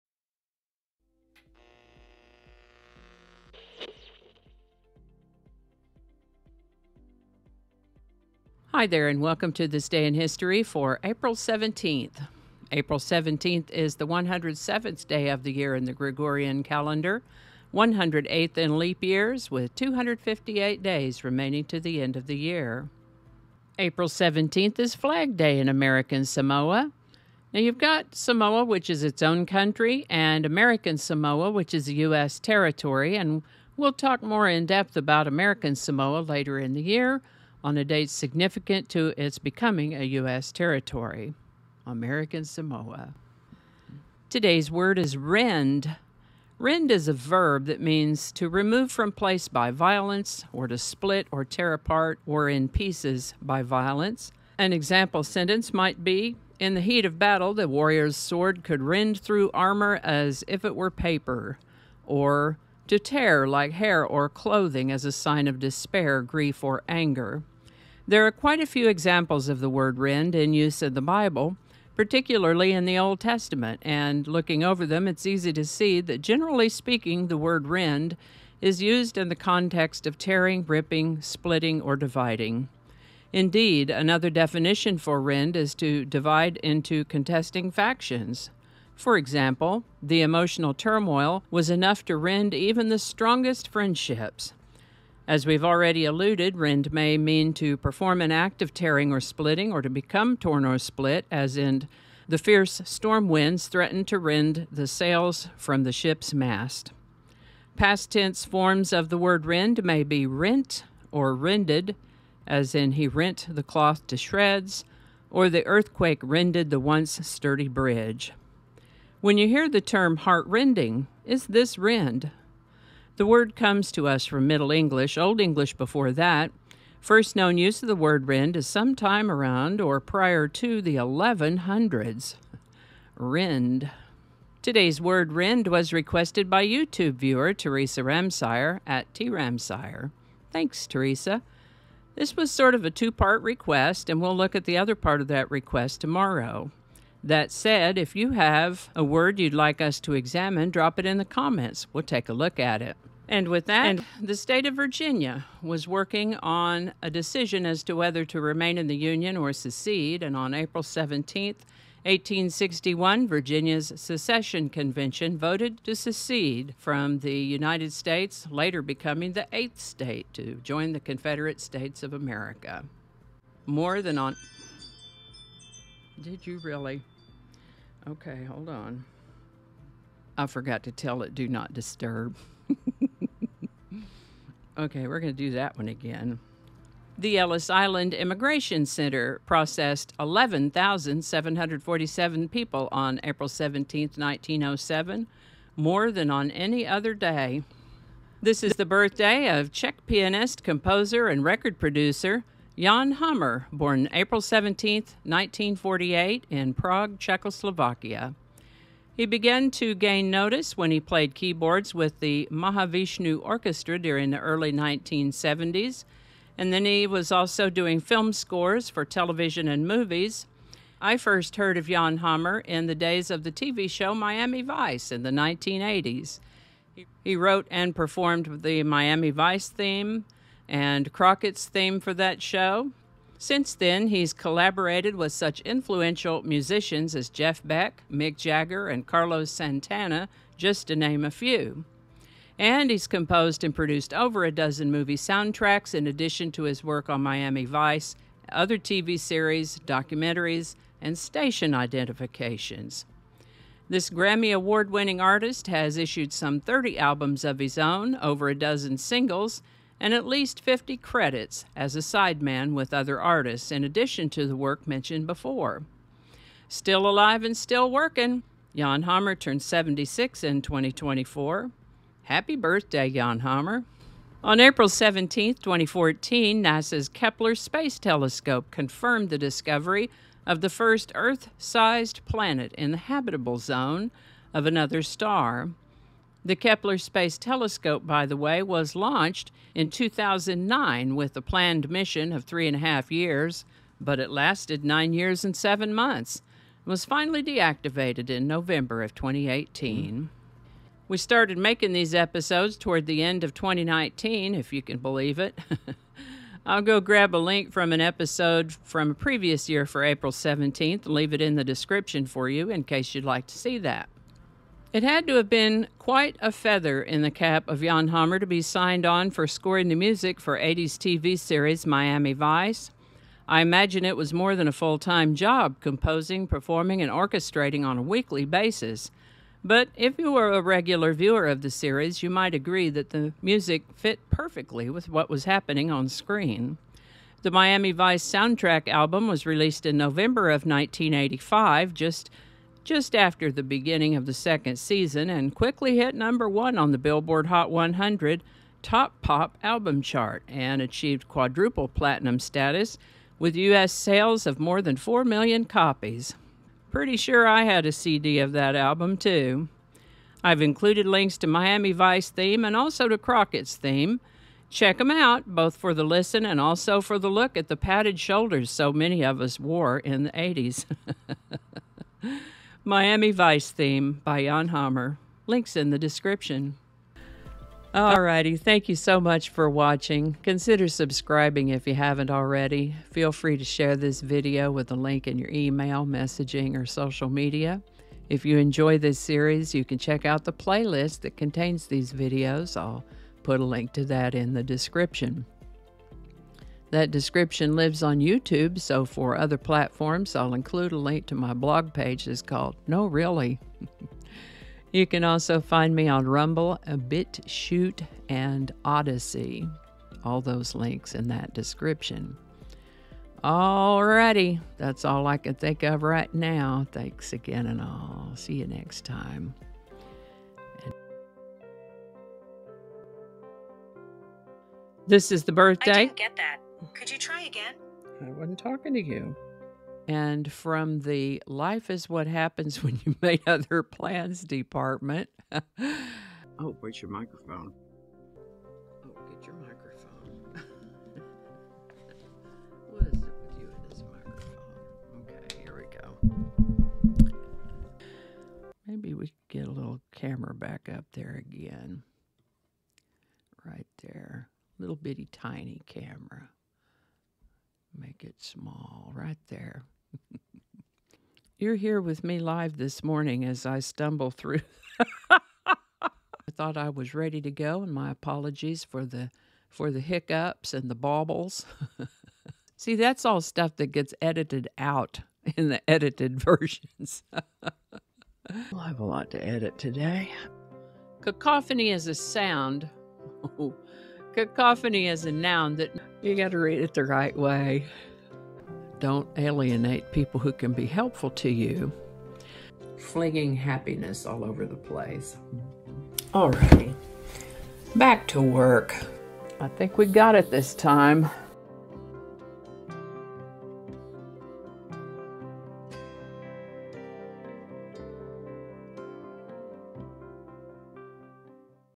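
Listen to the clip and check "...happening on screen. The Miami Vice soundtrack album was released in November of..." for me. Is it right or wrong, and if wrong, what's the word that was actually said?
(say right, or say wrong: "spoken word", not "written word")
right.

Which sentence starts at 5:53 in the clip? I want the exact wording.
sales of more than 4 million copies.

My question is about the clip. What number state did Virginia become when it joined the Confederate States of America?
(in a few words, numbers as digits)
8th.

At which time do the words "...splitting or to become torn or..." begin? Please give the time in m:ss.
1:39.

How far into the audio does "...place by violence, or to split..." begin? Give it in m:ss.
0:49.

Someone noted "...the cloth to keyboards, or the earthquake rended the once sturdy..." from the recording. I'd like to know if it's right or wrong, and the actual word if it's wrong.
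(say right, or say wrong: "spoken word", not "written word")
wrong: "shreds", not "keyboards".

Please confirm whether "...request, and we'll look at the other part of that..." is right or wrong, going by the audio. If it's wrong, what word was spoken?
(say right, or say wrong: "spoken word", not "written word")
right.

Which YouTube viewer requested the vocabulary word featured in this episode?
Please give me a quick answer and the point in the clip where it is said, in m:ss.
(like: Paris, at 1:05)
Teresa Ramsire, at 2:17.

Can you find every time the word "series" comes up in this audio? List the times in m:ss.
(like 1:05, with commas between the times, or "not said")
4:09, 5:21, 5:31, 6:29.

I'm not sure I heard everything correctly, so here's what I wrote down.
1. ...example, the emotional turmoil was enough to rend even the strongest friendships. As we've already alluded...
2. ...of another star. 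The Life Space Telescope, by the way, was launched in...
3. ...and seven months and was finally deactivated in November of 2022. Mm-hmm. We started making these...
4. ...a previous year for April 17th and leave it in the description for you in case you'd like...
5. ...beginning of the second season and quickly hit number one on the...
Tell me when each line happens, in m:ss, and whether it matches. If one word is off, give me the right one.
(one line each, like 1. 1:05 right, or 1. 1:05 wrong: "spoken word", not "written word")
1. 1:29 right
2. 4:44 wrong: "Kepler", not "Life"
3. 4:55 wrong: "2018", not "2022"
4. 5:09 right
5. 5:43 right.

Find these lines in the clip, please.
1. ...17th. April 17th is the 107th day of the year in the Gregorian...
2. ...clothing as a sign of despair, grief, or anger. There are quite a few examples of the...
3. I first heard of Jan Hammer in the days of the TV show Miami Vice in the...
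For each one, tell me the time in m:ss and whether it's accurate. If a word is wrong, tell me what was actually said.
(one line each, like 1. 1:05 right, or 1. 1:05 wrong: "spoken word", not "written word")
1. 0:11 right
2. 1:04 right
3. 3:40 right.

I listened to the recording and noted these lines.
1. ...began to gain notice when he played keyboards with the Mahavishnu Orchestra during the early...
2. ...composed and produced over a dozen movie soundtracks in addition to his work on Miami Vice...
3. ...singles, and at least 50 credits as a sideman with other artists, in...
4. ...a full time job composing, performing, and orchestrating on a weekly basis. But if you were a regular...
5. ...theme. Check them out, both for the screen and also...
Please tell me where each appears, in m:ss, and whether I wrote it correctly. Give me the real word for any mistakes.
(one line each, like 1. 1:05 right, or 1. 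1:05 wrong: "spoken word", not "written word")
1. 3:29 right
2. 4:03 right
3. 4:18 right
4. 5:24 right
5. 6:03 wrong: "listen", not "screen".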